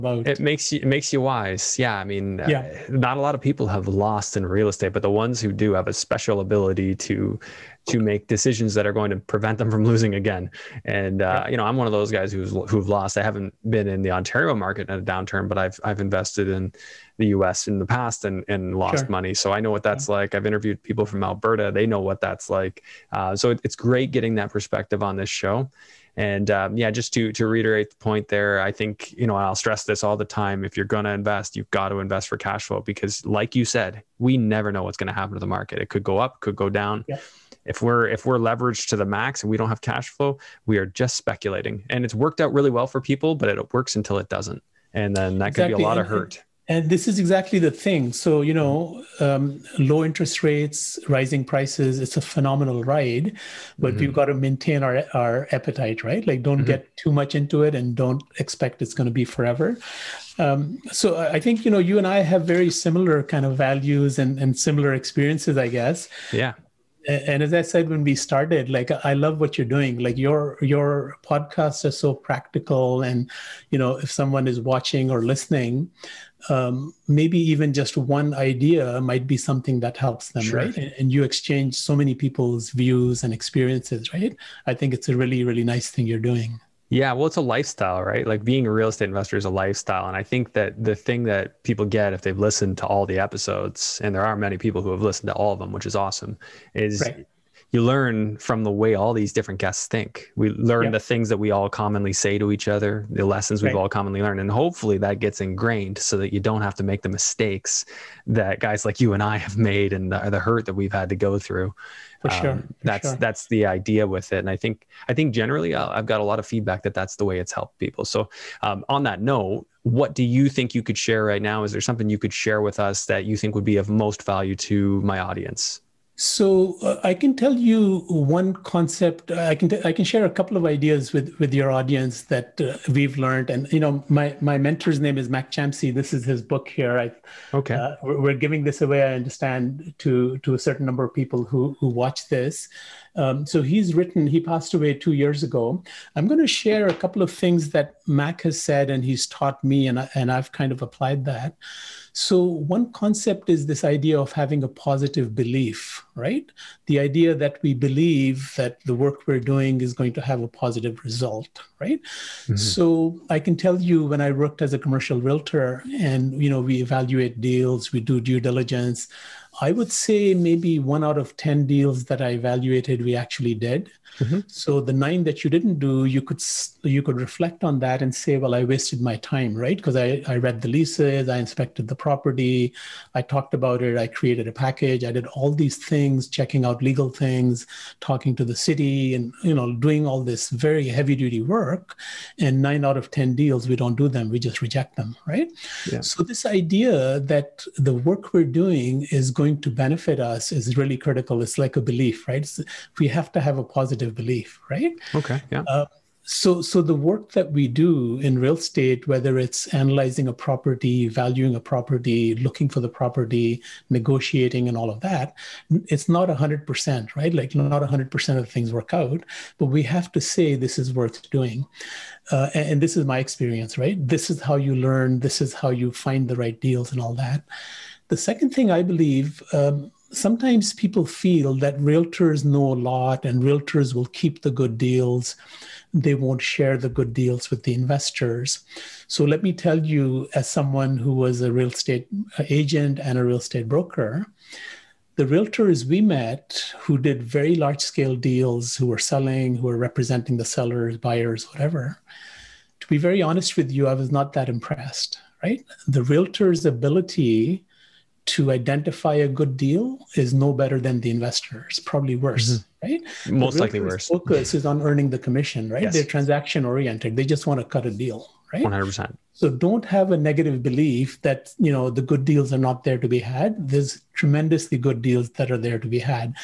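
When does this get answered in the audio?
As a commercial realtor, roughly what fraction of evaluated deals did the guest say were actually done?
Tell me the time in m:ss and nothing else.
2:50.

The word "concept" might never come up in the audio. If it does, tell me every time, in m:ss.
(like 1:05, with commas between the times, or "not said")
2:08, 2:32.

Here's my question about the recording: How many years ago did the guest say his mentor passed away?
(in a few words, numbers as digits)
2.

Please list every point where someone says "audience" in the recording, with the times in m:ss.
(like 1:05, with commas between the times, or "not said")
2:05, 2:11.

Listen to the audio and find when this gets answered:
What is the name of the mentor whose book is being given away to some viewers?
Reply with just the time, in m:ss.
2:15.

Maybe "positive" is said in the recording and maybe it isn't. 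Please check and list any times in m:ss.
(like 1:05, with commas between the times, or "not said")
2:34, 2:40, 3:23.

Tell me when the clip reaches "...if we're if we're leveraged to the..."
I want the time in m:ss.
0:37.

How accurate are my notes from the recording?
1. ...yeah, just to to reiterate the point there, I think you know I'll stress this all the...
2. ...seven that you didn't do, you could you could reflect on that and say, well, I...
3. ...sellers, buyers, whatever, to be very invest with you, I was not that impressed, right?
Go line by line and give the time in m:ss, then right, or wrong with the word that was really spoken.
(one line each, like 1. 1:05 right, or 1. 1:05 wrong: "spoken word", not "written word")
1. 0:26 right
2. 2:54 wrong: "nine", not "seven"
3. 4:10 wrong: "honest", not "invest".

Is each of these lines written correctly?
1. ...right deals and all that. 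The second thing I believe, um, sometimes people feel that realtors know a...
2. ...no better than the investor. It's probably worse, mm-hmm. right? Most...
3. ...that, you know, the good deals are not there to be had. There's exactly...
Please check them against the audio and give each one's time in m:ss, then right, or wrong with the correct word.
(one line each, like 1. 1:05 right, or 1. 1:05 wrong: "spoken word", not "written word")
1. 3:46 right
2. 4:20 right
3. 4:31 wrong: "tremendously", not "exactly".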